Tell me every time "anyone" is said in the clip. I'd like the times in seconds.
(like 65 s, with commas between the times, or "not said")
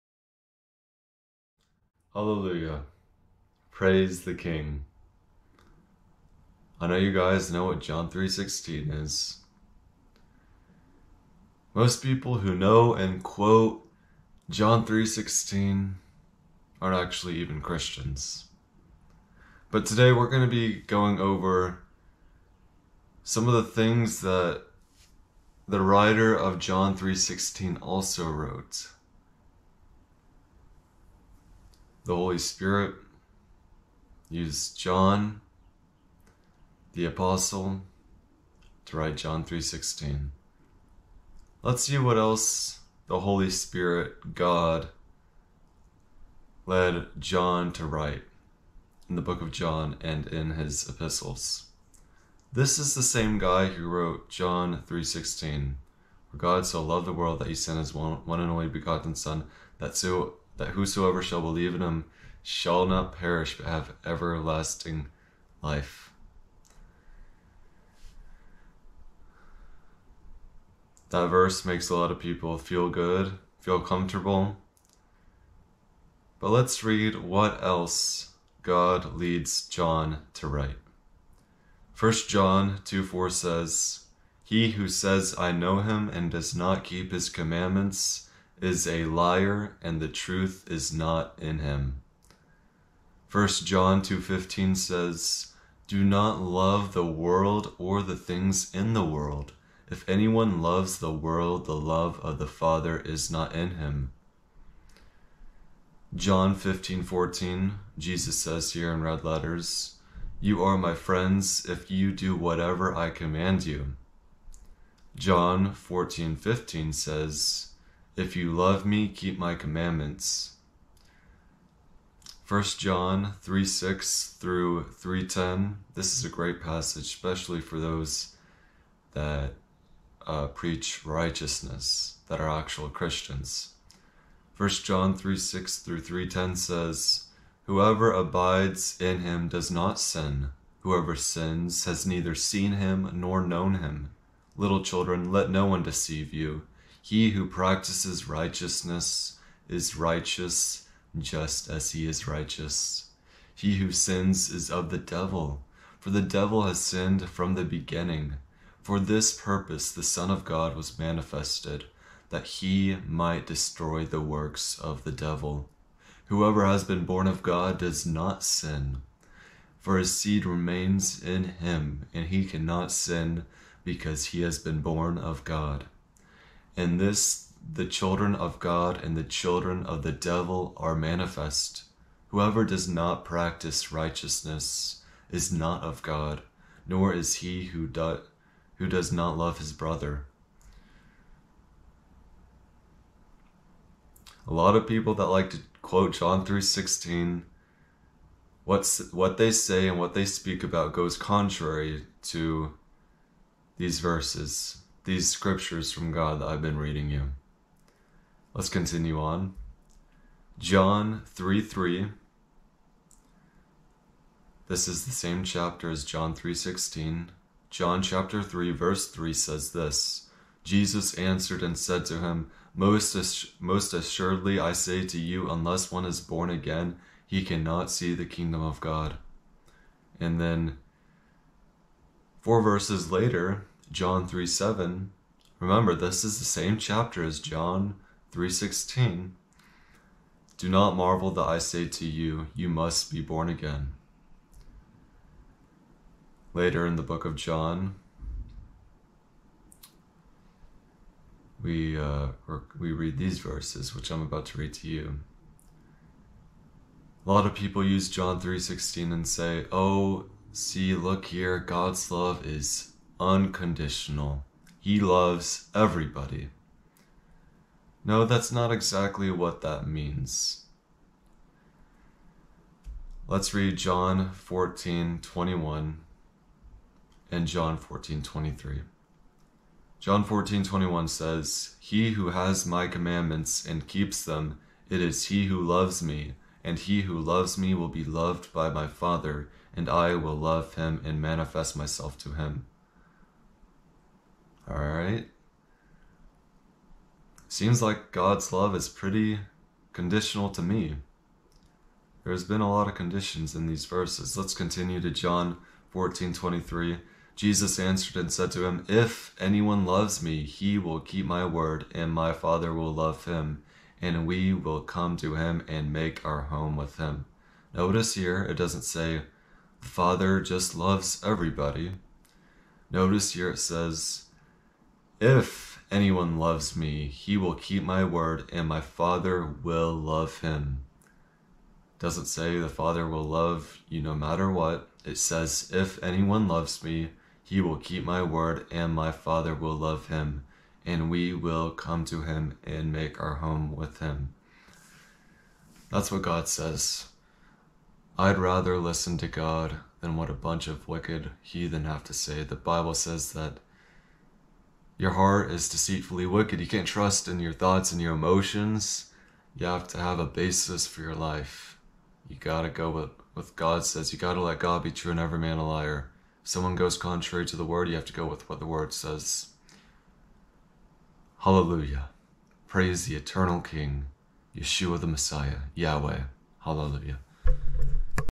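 100 s, 309 s, 325 s, 336 s.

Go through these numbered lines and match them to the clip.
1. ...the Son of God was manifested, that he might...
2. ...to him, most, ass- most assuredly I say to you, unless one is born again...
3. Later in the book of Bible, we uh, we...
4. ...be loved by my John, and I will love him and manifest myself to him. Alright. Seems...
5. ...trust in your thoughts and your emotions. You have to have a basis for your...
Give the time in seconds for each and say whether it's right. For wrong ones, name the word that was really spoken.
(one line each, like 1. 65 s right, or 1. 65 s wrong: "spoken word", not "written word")
1. 159 s right
2. 222 s right
3. 246 s wrong: "John", not "Bible"
4. 287 s wrong: "Father", not "John"
5. 356 s right.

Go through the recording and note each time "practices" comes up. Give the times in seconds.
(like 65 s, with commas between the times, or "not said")
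147 s, 183 s.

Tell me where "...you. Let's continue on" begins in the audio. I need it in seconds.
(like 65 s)
207 s.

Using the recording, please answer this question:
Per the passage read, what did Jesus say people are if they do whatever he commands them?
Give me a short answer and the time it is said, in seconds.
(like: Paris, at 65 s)
my friends, at 110 s.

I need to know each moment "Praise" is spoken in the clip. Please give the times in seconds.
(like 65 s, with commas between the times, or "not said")
3 s, 372 s.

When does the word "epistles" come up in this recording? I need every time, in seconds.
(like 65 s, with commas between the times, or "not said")
50 s.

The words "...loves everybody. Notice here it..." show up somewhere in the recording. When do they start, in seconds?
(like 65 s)
320 s.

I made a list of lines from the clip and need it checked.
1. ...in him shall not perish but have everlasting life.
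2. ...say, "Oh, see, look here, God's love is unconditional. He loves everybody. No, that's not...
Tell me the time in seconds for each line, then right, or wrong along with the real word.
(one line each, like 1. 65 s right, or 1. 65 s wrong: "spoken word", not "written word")
1. 61 s right
2. 259 s right.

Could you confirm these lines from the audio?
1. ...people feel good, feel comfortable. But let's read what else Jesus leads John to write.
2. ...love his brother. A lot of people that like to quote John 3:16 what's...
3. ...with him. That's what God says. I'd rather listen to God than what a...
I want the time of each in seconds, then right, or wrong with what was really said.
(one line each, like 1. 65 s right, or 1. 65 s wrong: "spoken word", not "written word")
1. 72 s wrong: "God", not "Jesus"
2. 189 s right
3. 343 s right.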